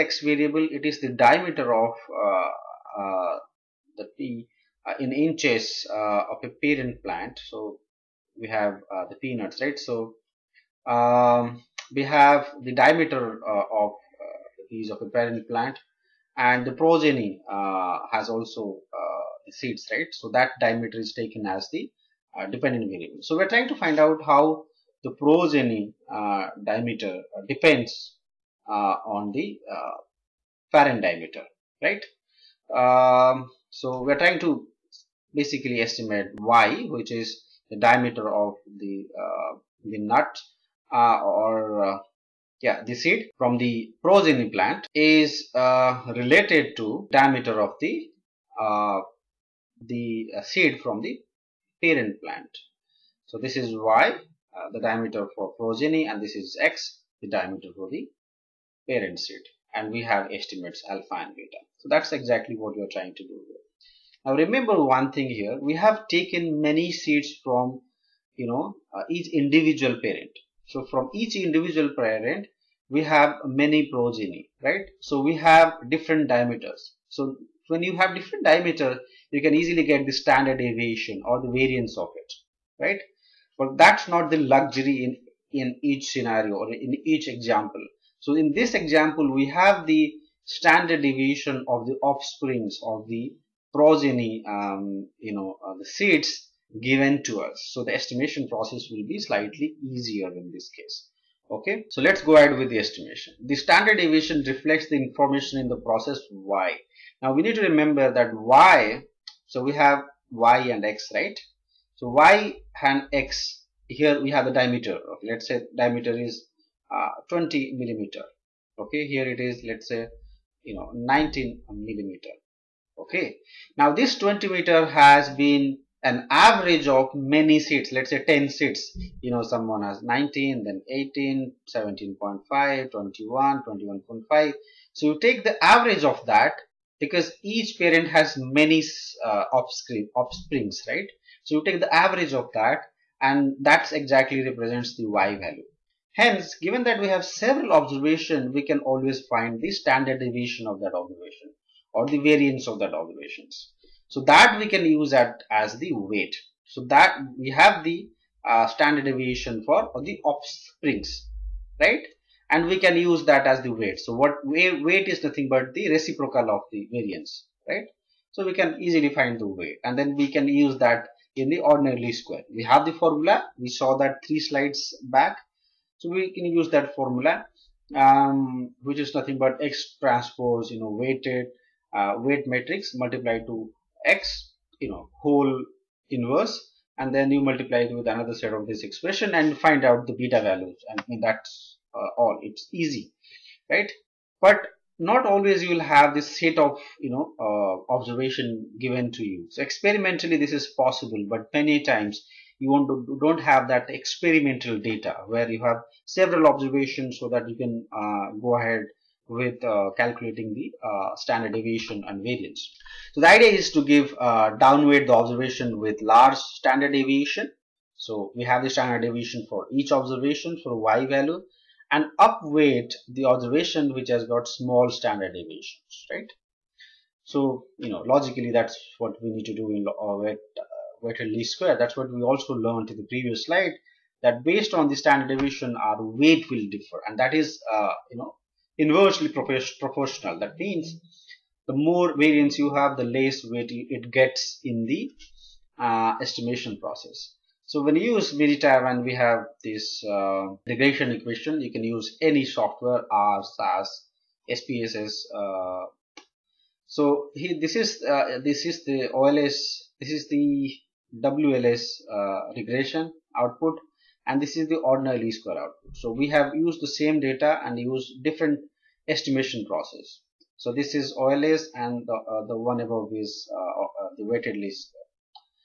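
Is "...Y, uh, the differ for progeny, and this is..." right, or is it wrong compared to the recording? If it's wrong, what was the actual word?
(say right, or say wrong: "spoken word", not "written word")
wrong: "diameter", not "differ".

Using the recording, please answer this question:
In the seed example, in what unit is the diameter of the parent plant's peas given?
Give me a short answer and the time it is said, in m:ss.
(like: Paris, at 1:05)
inches, at 0:05.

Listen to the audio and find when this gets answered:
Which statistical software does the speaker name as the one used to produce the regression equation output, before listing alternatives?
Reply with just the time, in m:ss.
4:08.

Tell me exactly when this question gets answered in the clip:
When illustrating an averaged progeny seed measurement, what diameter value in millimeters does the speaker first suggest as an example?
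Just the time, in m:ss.
1:57.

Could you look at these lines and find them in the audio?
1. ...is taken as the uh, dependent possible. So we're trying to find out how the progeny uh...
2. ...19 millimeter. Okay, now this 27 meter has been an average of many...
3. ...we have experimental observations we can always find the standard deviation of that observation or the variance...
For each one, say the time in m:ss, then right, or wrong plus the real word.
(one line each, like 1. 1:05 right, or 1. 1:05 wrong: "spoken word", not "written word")
1. 0:20 wrong: "variable", not "possible"
2. 2:00 wrong: "20", not "27"
3. 2:27 wrong: "several", not "experimental".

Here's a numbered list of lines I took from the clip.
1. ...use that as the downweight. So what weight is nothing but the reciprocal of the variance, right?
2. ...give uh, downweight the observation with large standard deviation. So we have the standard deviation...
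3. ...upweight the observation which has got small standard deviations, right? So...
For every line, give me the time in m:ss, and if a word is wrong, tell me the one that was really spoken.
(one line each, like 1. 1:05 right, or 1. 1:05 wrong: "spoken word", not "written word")
1. 2:42 wrong: "weight", not "downweight"
2. 3:33 right
3. 3:42 right.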